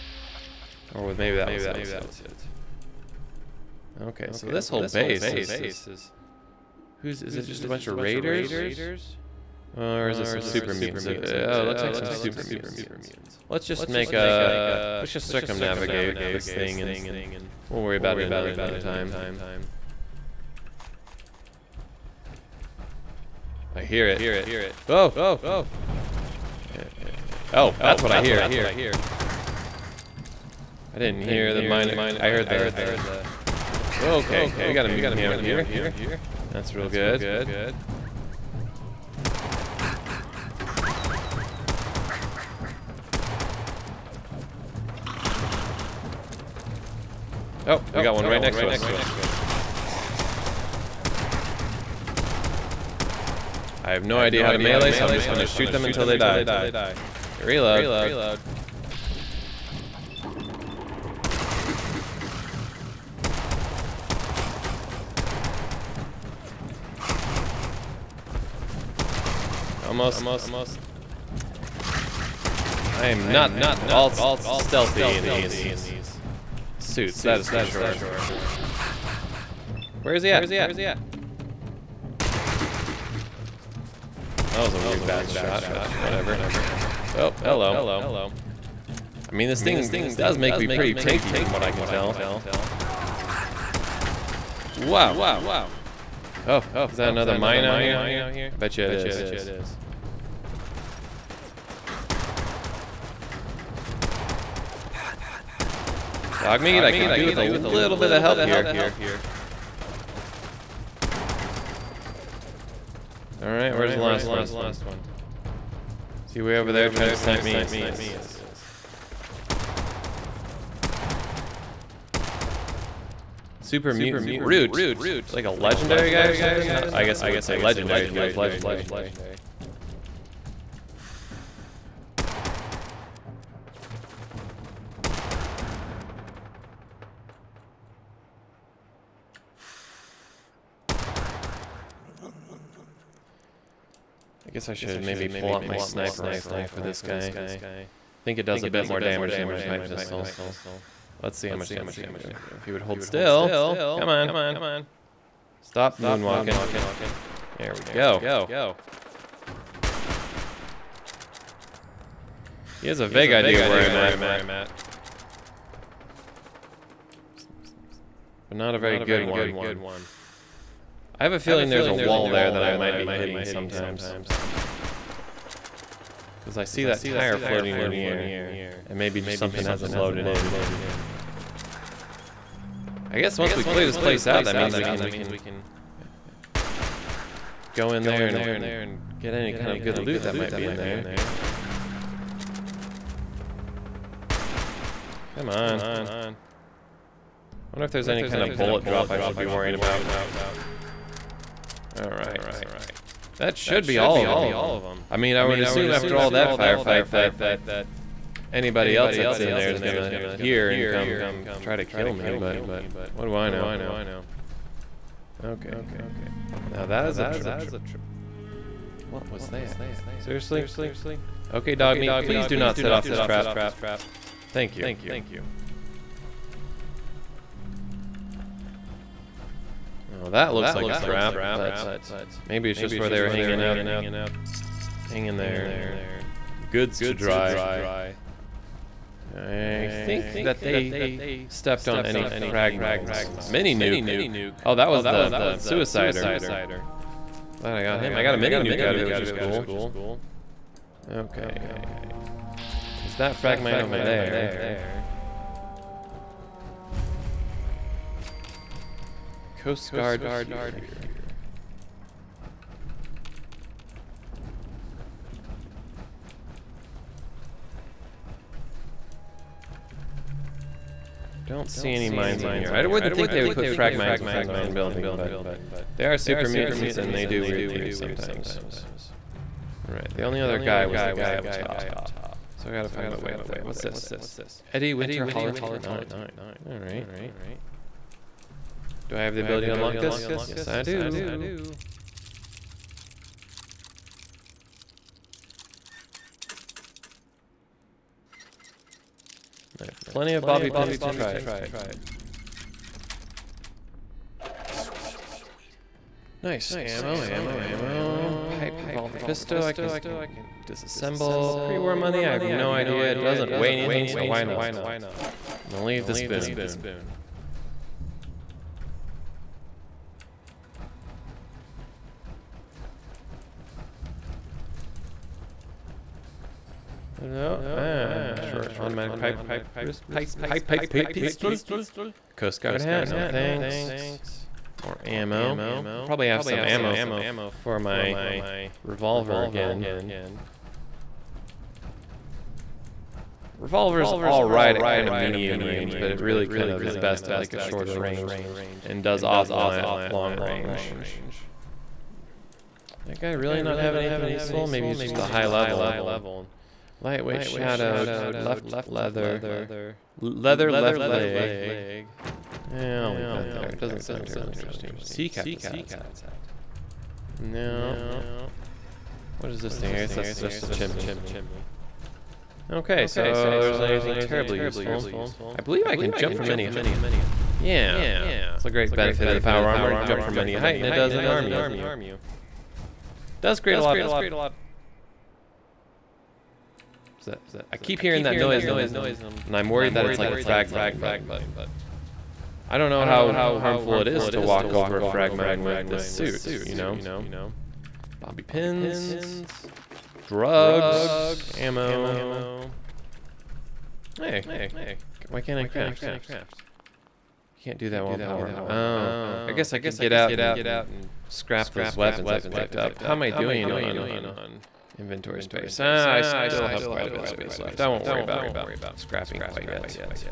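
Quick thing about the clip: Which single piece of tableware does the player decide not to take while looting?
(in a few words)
Spoon.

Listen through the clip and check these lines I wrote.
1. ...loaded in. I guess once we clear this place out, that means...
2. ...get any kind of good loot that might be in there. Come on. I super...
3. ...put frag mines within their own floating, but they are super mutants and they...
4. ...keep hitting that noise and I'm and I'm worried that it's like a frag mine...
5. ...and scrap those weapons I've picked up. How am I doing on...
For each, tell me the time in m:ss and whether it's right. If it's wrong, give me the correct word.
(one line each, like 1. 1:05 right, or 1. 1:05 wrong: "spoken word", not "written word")
1. 2:59 right
2. 3:09 wrong: "wonder", not "super"
3. 4:33 wrong: "building", not "floating"
4. 6:27 wrong: "hearing", not "hitting"
5. 6:50 right.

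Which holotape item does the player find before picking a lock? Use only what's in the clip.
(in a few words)
Eddie Winter Holotape 9.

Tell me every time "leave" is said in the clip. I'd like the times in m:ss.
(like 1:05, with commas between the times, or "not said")
5:15, 6:03.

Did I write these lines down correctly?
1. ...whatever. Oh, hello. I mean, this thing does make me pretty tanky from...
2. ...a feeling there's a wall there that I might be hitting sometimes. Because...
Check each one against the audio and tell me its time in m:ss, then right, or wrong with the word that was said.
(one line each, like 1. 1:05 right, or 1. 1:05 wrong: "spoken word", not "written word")
1. 1:26 right
2. 2:51 right.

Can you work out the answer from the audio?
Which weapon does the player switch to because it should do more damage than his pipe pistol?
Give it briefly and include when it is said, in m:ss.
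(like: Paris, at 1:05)
Sniper rifle, at 2:25.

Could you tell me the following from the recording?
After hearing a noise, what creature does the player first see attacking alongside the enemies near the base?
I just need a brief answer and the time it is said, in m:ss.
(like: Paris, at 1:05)
Mutant hound, at 0:34.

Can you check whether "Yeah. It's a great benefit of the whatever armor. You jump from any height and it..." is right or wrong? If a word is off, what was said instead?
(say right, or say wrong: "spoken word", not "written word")
wrong: "power", not "whatever".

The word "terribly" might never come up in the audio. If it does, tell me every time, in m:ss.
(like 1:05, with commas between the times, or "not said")
6:04, 6:14.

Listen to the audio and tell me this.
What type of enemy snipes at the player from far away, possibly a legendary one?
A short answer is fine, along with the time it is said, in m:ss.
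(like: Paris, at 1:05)
Super Mutant Brute, at 2:03.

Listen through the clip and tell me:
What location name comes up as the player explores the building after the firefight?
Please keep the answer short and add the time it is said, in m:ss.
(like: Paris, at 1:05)
Coast Guard Pier, at 4:19.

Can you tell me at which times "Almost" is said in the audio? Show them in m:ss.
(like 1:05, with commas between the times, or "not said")
1:09.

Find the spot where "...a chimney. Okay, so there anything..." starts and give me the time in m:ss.
6:10.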